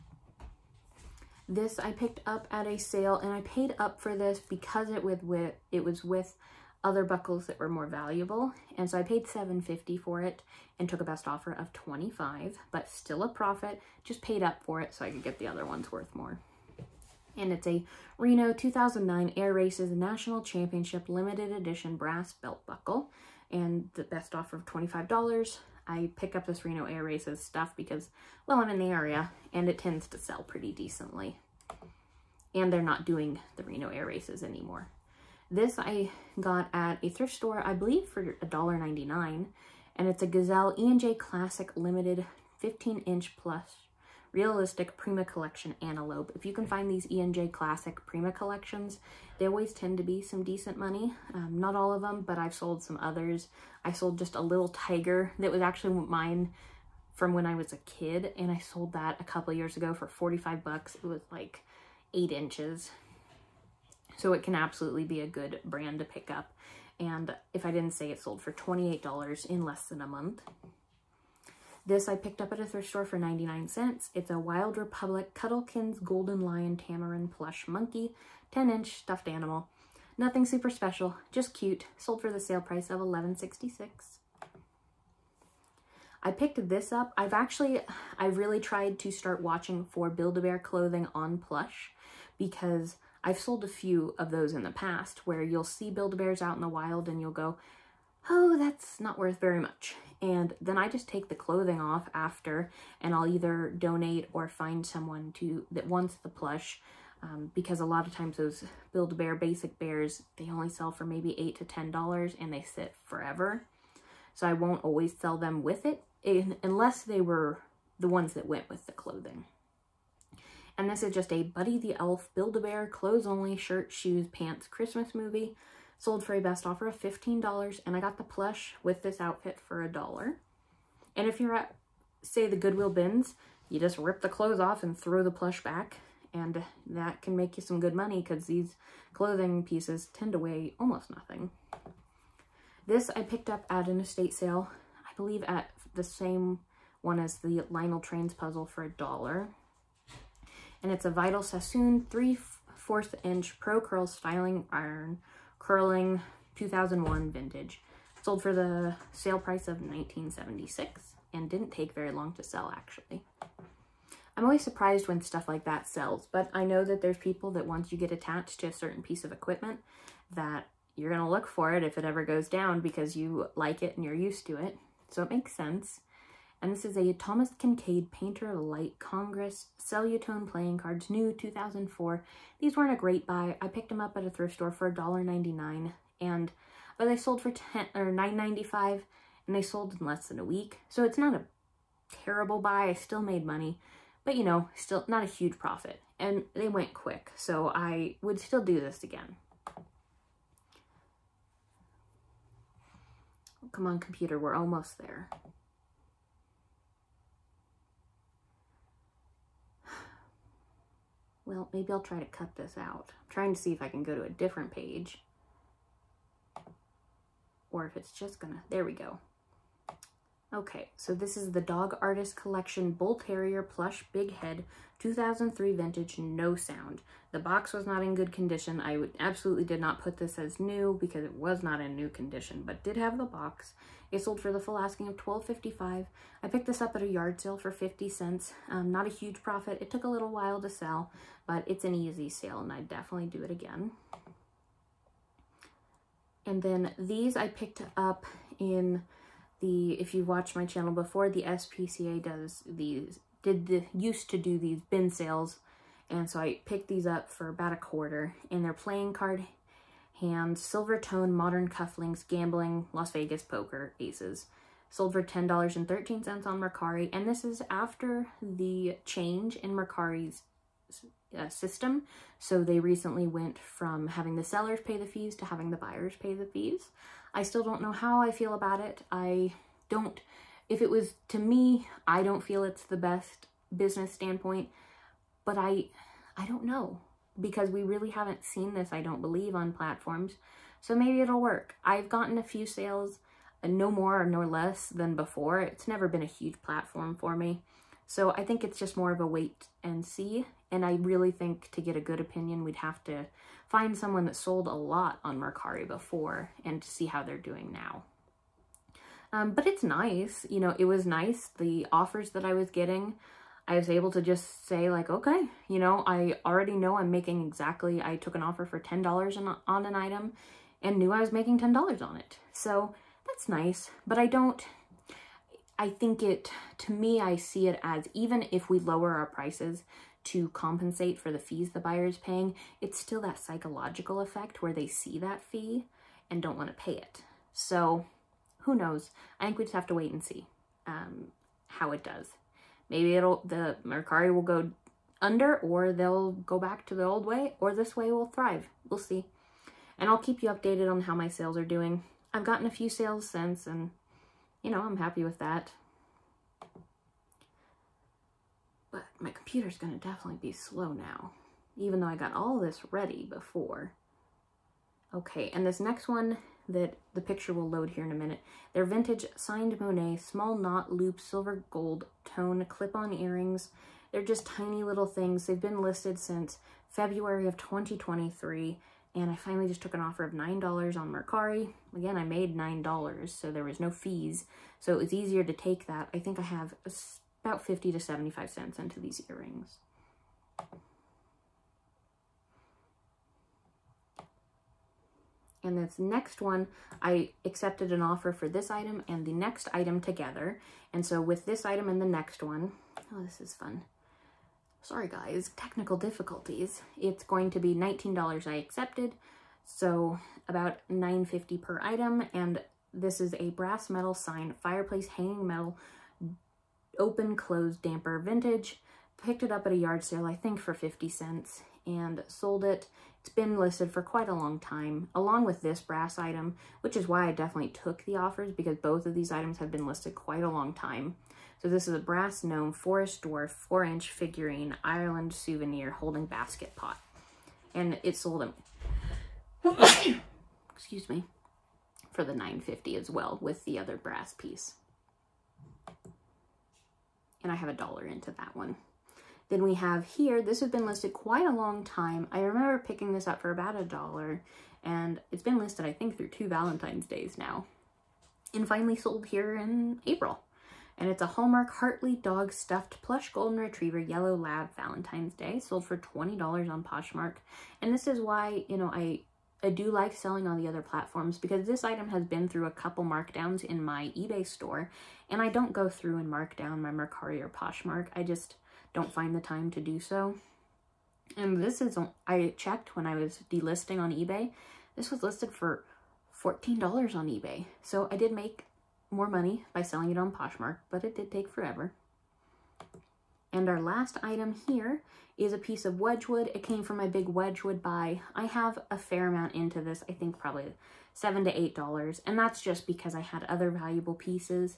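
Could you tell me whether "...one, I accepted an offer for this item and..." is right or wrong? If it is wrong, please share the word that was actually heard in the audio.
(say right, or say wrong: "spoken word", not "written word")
right.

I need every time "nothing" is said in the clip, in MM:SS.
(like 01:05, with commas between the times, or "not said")
01:20, 02:21.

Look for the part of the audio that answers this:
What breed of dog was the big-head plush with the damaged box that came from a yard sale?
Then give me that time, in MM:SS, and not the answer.
03:42.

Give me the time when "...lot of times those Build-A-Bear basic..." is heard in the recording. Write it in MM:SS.
01:47.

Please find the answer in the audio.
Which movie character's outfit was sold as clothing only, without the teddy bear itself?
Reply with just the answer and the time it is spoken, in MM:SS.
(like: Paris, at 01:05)
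Buddy the Elf, at 02:01.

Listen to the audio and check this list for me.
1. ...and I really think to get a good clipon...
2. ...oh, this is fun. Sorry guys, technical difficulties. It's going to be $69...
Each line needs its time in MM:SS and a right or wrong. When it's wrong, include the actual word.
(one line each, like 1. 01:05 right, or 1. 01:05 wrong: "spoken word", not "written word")
1. 05:00 wrong: "opinion", not "clipon"
2. 06:43 wrong: "19", not "69".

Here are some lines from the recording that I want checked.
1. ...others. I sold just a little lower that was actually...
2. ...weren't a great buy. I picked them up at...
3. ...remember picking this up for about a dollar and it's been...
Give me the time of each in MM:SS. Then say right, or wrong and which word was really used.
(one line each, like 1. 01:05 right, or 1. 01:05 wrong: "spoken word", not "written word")
1. 00:52 wrong: "tiger", not "lower"
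2. 03:02 right
3. 07:32 right.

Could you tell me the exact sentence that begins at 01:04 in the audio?
So it can absolutely be a good brand to pick up.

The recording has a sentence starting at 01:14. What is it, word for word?
It's a Wild Republic Cuddlekins Golden Lion Tamarin plush monkey, 10 inch stuffed animal.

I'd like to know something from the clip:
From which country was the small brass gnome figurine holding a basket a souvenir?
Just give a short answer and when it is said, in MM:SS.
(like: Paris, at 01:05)
Ireland, at 07:14.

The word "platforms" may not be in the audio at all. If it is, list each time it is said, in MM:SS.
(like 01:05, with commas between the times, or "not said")
04:49, 04:56, 07:50.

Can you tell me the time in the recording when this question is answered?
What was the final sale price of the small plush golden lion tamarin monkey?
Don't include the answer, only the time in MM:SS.
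01:23.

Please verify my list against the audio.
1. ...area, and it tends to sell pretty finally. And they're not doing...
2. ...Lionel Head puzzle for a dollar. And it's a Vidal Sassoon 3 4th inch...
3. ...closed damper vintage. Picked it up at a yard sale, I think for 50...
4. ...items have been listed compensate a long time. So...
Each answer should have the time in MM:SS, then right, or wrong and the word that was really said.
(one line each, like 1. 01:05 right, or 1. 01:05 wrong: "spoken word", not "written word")
1. 00:28 wrong: "decently", not "finally"
2. 02:27 wrong: "Trains", not "Head"
3. 06:57 right
4. 07:09 wrong: "quite", not "compensate".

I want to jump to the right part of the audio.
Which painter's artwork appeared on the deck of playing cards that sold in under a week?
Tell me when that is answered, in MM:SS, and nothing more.
02:57.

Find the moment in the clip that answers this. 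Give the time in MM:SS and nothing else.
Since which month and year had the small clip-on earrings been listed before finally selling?
06:16.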